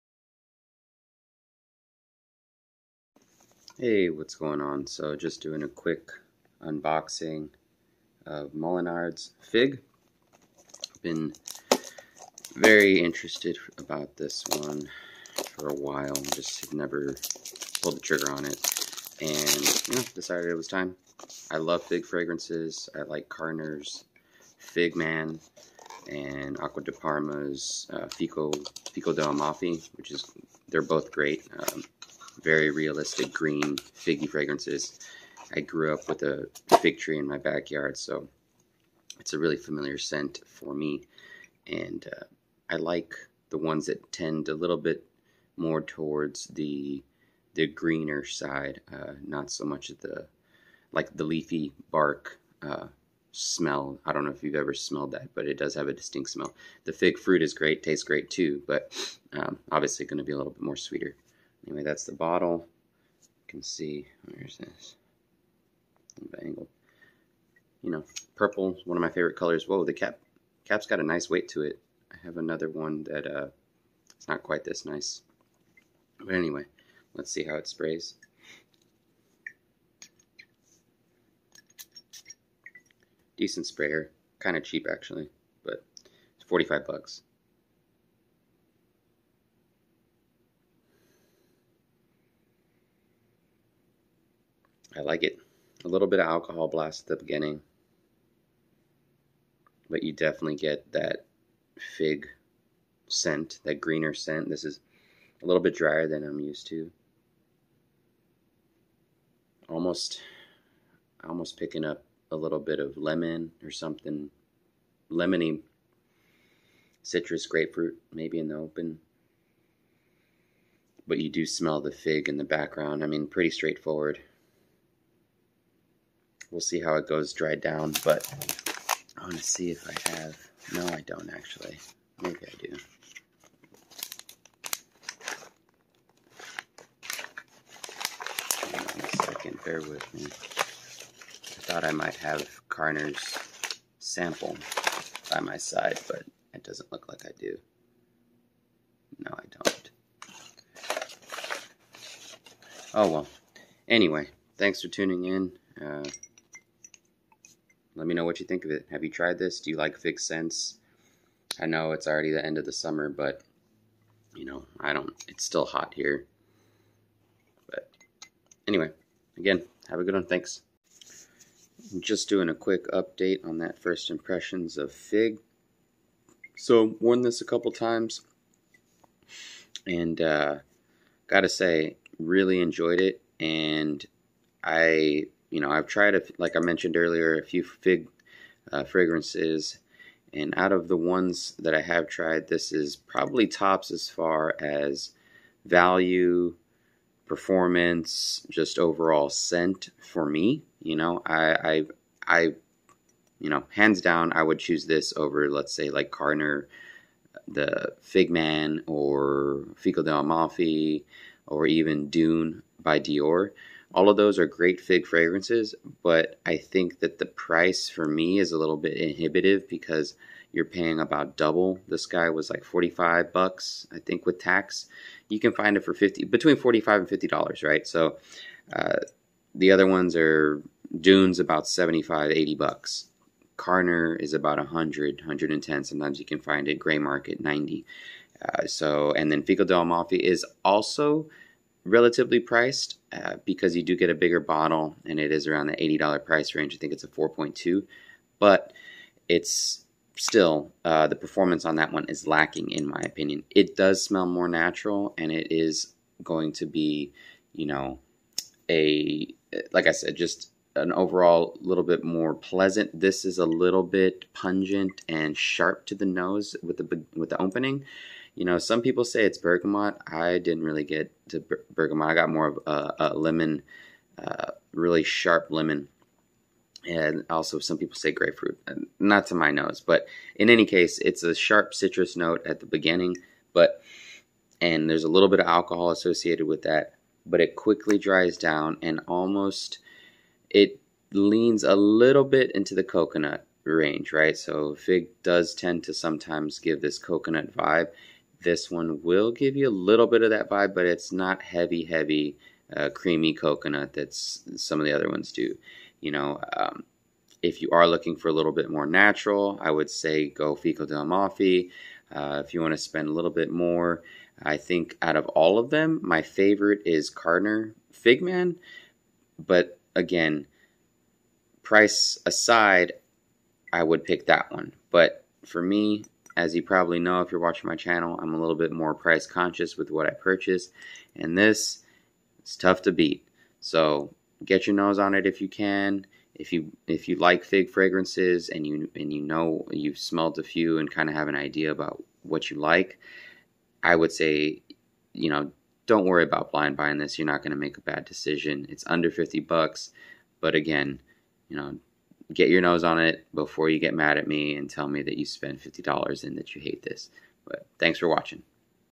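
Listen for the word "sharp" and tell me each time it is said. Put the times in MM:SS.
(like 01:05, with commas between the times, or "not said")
04:25, 04:35, 04:41.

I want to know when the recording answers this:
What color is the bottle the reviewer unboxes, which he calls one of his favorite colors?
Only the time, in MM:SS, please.
01:08.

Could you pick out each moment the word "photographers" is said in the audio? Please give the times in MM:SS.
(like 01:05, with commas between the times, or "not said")
not said.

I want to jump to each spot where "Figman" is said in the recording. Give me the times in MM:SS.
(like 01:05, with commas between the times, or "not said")
03:28, 05:17.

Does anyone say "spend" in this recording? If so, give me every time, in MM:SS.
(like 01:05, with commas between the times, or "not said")
05:12, 05:55.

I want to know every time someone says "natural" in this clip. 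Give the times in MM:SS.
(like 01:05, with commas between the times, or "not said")
04:14, 05:08.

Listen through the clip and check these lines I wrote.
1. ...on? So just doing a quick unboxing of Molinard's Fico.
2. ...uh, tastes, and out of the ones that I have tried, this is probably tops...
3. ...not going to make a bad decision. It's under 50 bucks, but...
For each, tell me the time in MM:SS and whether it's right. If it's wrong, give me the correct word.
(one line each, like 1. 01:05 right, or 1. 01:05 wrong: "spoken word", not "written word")
1. 00:04 wrong: "Fig", not "Fico"
2. 03:08 wrong: "fragrances", not "tastes"
3. 05:47 right.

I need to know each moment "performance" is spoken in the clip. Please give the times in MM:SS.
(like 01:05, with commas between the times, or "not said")
03:17, 04:11.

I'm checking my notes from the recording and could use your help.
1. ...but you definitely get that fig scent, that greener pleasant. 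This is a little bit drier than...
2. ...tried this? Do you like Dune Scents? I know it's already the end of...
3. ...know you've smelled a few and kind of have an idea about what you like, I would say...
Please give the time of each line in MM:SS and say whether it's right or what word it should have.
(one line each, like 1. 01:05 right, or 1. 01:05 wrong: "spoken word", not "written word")
1. 01:39 wrong: "scent", not "pleasant"
2. 02:39 wrong: "Fig", not "Dune"
3. 05:39 right.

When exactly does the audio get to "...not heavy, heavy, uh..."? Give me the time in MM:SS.
05:01.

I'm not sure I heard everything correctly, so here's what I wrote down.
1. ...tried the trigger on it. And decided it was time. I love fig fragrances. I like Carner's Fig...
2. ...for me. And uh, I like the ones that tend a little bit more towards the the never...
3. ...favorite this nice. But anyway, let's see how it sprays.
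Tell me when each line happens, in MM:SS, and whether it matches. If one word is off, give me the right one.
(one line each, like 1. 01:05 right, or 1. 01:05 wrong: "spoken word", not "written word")
1. 00:17 wrong: "pulled", not "tried"
2. 00:40 wrong: "greener", not "never"
3. 01:14 wrong: "quite", not "favorite".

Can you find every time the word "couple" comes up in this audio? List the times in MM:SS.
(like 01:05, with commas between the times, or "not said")
02:57.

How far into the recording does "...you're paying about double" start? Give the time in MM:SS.
03:40.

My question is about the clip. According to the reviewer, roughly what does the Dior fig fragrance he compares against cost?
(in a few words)
$75-80.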